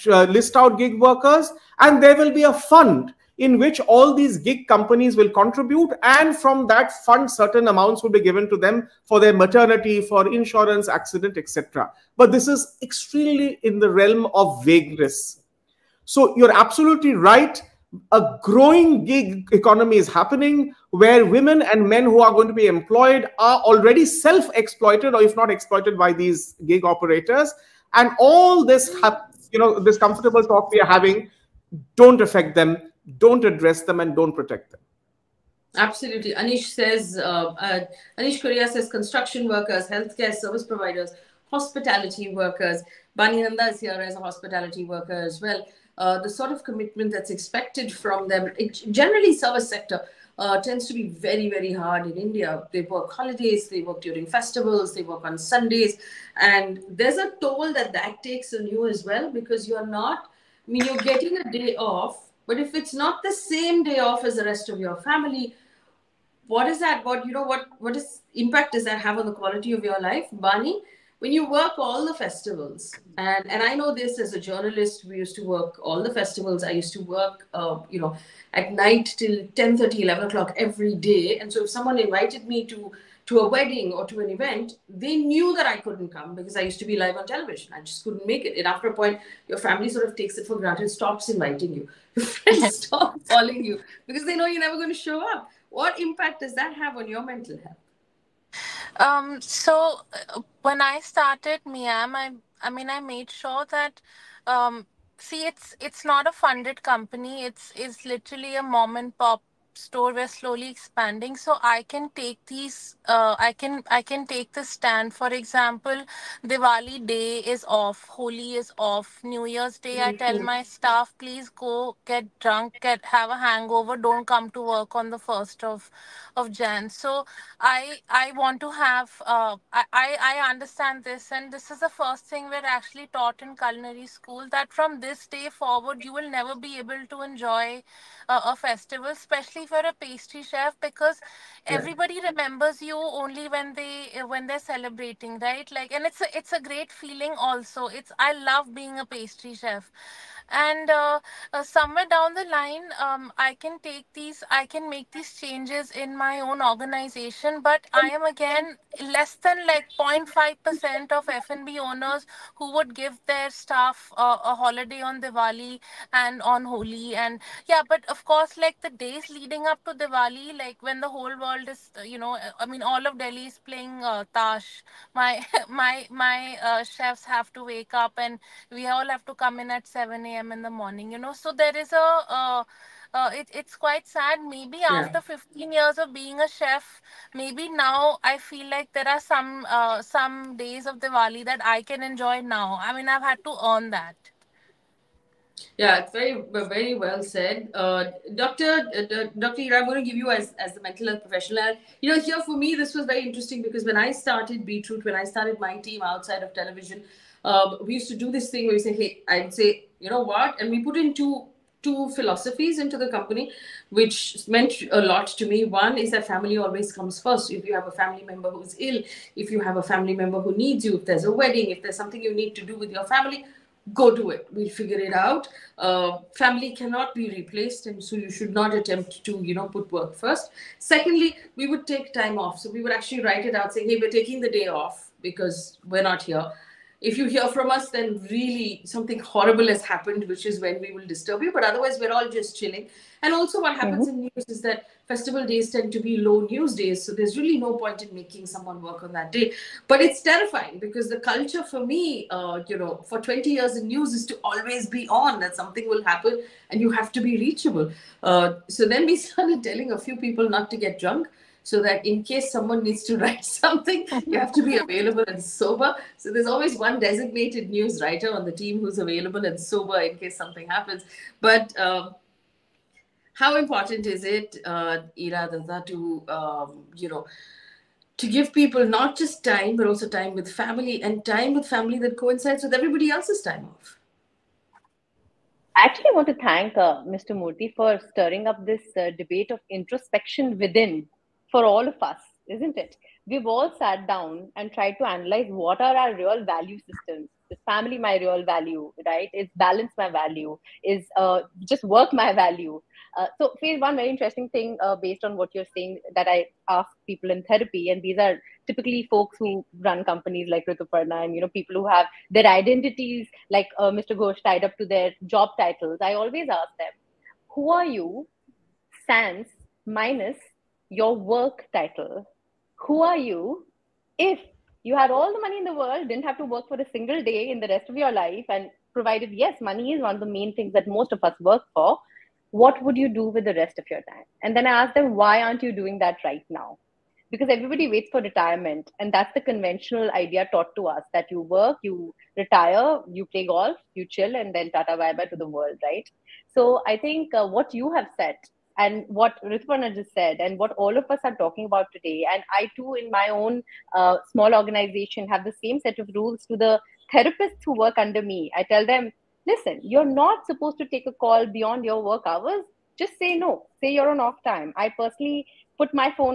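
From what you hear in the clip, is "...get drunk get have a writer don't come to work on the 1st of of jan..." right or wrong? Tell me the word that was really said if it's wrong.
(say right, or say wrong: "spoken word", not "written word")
wrong: "hangover", not "writer".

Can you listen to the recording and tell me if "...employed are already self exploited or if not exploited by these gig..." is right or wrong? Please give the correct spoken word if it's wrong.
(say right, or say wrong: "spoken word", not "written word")
right.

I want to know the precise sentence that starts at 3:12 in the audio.
I mean, I've had to earn that.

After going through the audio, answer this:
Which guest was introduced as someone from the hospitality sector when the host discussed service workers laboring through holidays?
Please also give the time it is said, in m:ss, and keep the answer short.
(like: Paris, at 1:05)
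Bani Nanda, at 0:43.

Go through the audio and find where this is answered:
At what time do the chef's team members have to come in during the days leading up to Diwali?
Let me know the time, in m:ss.
2:59.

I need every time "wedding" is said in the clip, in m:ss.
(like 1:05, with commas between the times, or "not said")
1:23, 3:41.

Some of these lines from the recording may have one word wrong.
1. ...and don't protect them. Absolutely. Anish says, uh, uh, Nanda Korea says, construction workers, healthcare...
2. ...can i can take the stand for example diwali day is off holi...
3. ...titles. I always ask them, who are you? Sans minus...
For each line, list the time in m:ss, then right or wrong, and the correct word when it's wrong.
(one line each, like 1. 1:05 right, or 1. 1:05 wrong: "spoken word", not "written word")
1. 0:34 wrong: "Anish", not "Nanda"
2. 1:53 right
3. 5:15 right.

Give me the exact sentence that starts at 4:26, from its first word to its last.
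So there's always one designated news writer on the team who's available and sober in case something happens.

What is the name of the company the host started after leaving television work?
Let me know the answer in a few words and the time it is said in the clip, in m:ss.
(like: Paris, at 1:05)
Beatroot, at 3:24.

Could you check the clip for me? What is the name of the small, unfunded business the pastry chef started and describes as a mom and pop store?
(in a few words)
Miam.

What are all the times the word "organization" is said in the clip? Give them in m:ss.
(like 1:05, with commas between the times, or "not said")
2:36, 5:54.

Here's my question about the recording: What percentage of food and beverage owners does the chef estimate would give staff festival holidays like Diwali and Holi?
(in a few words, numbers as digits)
0.5%.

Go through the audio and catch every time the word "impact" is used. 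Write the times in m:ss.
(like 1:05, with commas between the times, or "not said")
1:08, 1:35.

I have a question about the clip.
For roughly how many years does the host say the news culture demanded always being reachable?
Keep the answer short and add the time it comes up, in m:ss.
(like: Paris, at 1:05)
20, at 4:13.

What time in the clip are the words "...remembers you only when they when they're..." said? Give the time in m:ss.
2:22.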